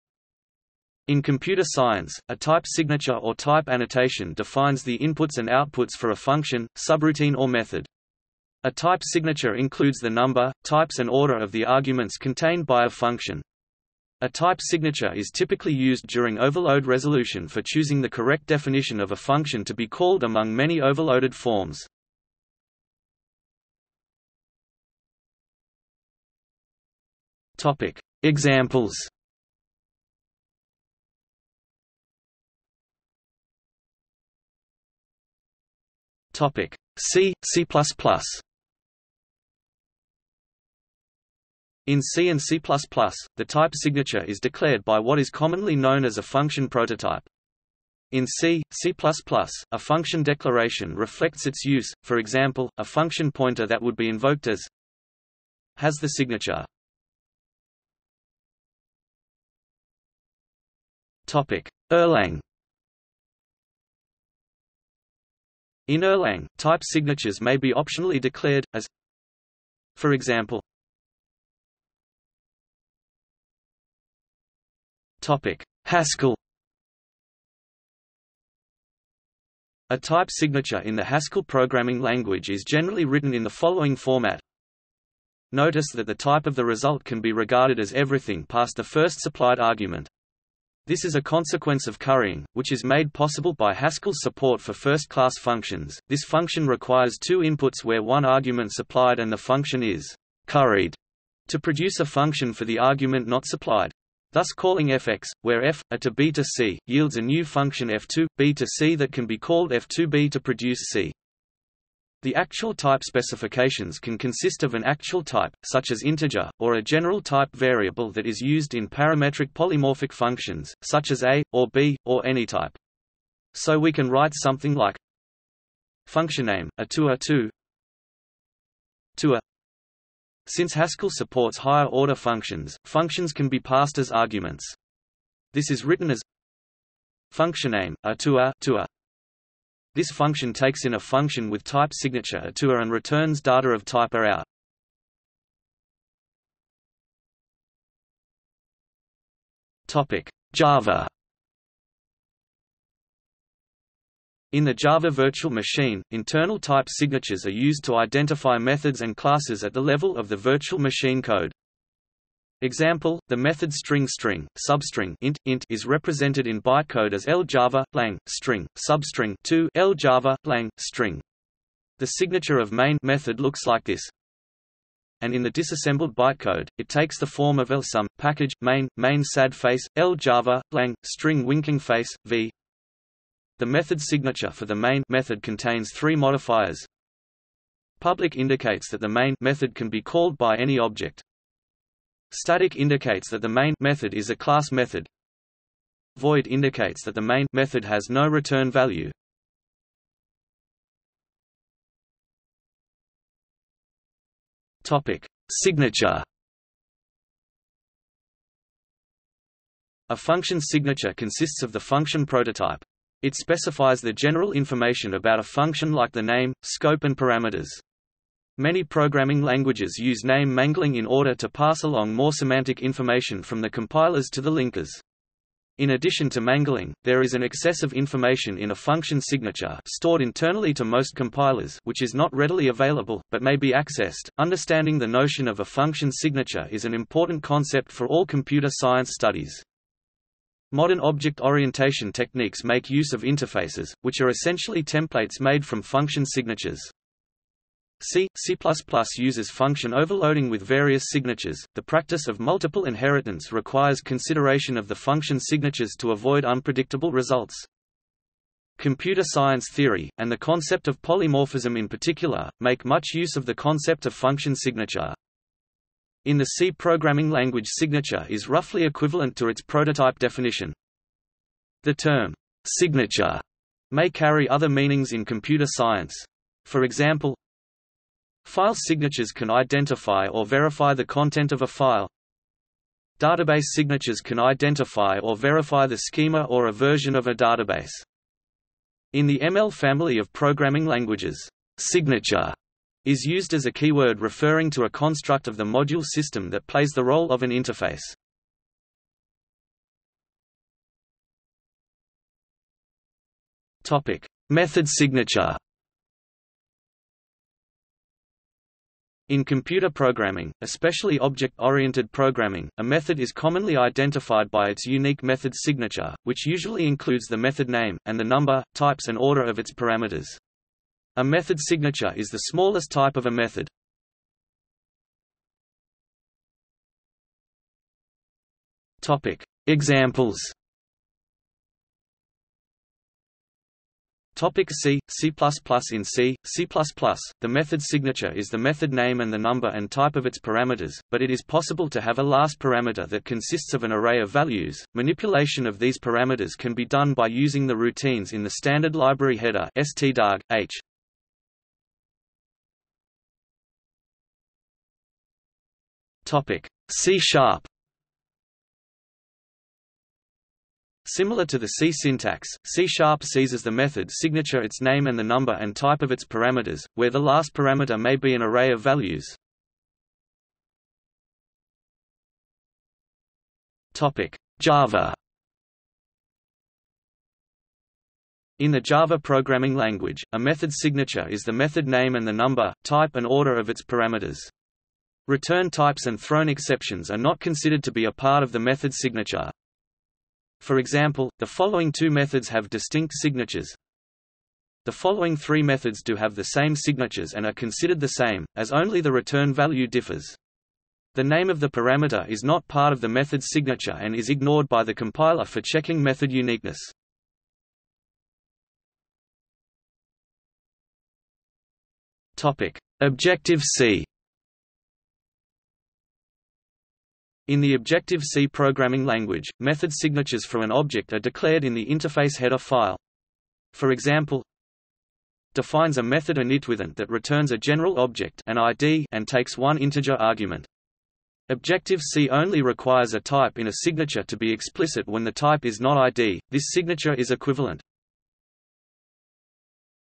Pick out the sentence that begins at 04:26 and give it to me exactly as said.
In the C programming language signature is roughly equivalent to its prototype definition.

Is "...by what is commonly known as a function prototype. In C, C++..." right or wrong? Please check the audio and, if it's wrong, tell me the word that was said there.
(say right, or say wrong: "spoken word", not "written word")
right.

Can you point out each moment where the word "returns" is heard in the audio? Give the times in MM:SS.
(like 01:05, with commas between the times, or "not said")
02:22, 03:18, 06:25, 06:39, 07:07.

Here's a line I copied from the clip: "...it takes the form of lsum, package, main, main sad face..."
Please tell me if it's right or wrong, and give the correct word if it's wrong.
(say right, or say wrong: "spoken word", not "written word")
right.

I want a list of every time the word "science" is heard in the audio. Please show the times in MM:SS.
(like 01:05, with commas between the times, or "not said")
00:01, 03:58, 04:19, 04:35.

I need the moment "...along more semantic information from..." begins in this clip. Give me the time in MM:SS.
03:41.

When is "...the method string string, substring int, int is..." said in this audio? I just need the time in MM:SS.
02:43.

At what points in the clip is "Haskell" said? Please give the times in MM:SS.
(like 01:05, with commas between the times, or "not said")
01:15, 01:21, 01:33, 02:10.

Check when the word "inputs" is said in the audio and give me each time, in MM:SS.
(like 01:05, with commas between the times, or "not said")
00:04, 01:37.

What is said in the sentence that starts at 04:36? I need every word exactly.
For example, File signatures can identify or verify the content of a file.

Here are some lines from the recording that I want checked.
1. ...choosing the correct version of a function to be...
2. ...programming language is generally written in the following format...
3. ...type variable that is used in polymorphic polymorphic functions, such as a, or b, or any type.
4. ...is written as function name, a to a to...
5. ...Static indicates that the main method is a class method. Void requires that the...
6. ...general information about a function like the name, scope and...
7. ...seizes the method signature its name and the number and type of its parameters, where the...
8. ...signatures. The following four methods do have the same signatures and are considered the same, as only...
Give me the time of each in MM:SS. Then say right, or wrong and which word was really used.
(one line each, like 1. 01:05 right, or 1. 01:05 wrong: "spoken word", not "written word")
1. 00:17 wrong: "definition", not "version"
2. 01:21 right
3. 01:57 wrong: "parametric", not "polymorphic"
4. 02:15 right
5. 03:12 wrong: "indicates", not "requires"
6. 03:34 right
7. 06:03 right
8. 06:33 wrong: "three", not "four".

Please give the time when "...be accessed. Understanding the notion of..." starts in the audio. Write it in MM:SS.
03:53.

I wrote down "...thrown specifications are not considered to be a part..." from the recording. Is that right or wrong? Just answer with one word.
wrong.